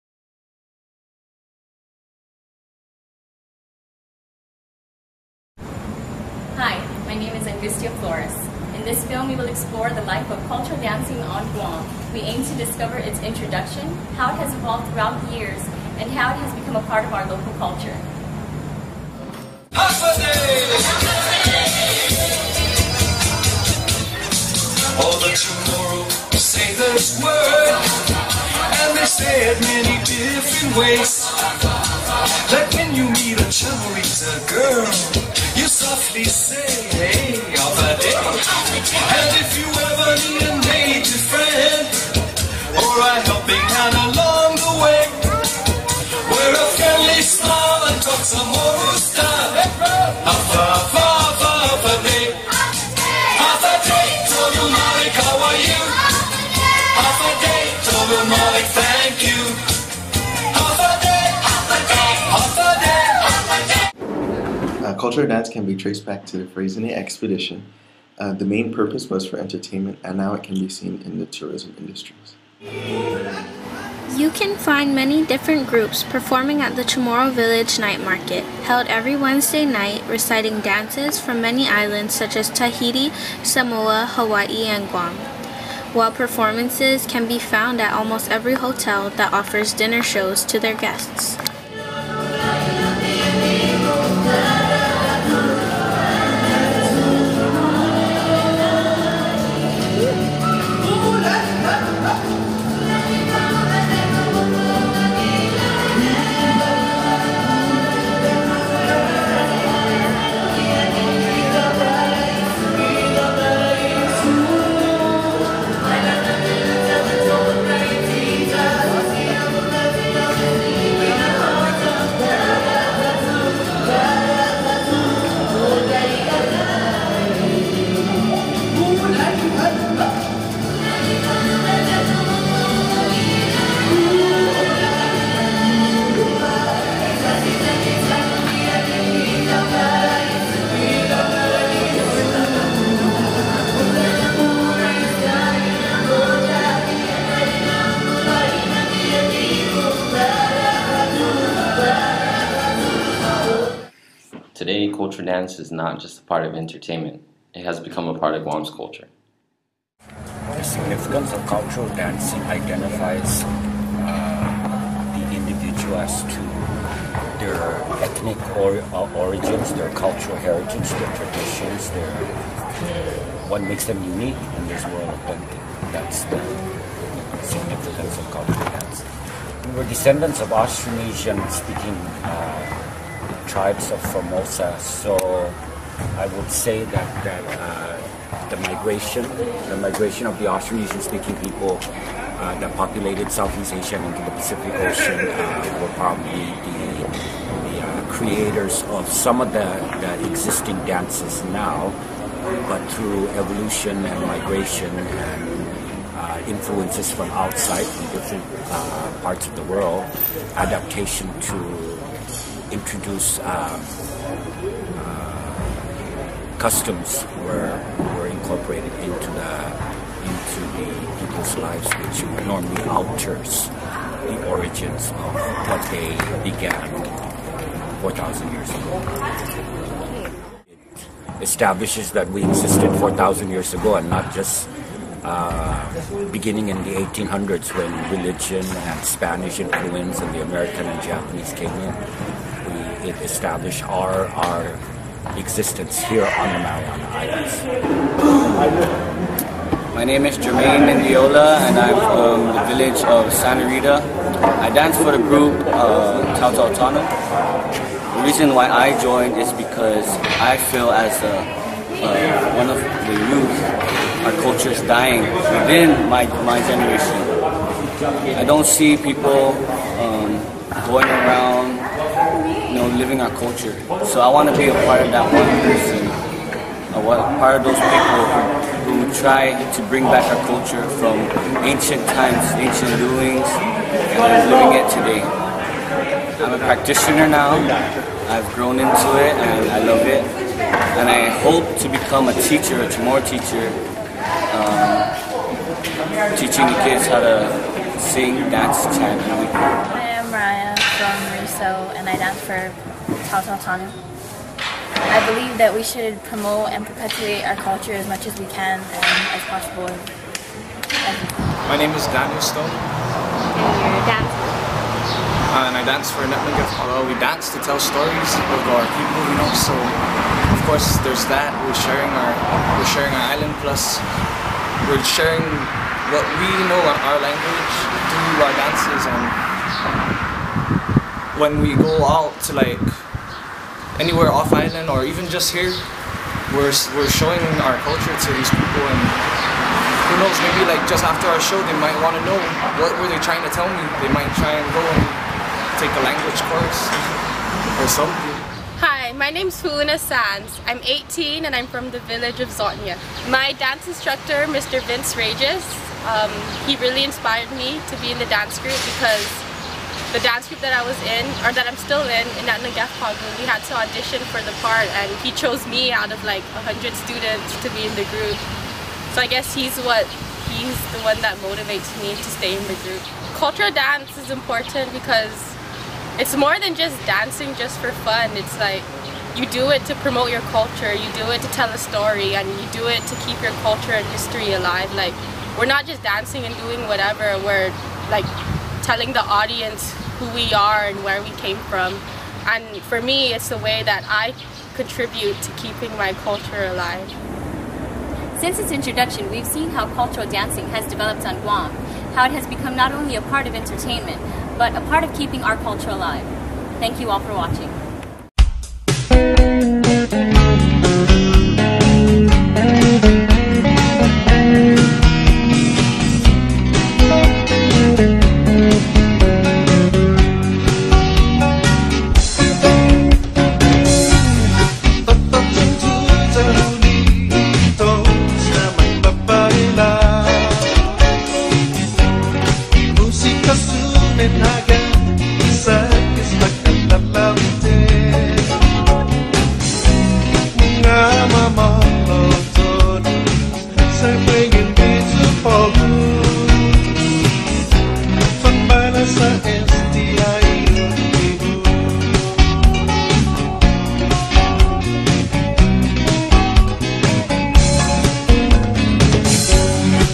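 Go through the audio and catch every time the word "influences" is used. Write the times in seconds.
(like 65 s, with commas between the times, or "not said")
206 s, 239 s.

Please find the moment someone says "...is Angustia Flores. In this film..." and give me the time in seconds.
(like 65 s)
7 s.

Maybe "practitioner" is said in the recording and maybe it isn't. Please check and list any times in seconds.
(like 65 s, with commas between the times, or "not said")
286 s.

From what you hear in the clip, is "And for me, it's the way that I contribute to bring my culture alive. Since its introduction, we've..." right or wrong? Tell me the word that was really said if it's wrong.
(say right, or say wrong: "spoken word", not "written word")
wrong: "keeping", not "bring".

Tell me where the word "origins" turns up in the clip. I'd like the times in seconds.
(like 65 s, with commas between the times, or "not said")
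169 s, 224 s.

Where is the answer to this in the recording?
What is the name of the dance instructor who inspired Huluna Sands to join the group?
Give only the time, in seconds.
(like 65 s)
354 s.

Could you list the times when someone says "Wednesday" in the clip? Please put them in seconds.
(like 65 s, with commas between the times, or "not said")
79 s.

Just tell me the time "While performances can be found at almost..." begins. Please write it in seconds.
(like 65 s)
85 s.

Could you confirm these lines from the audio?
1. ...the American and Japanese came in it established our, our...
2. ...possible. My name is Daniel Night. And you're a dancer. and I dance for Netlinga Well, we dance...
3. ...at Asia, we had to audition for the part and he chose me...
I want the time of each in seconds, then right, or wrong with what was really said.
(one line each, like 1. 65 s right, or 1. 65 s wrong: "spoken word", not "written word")
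1. 240 s right
2. 309 s wrong: "Stone", not "Night"
3. 362 s wrong: "Nagafpagun", not "Asia".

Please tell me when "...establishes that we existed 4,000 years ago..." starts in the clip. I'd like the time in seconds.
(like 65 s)
231 s.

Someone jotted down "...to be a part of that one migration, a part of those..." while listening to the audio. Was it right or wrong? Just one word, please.
wrong.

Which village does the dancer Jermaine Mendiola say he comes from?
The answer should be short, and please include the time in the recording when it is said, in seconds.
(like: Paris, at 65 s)
Santa Rita, at 253 s.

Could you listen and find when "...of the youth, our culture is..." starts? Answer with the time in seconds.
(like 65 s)
262 s.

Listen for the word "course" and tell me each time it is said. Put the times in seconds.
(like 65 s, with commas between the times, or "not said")
320 s, 346 s.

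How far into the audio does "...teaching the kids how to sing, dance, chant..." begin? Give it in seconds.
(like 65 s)
296 s.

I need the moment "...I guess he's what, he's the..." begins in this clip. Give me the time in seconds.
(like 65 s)
369 s.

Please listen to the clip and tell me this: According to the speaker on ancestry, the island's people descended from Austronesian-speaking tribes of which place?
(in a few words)
Formosa.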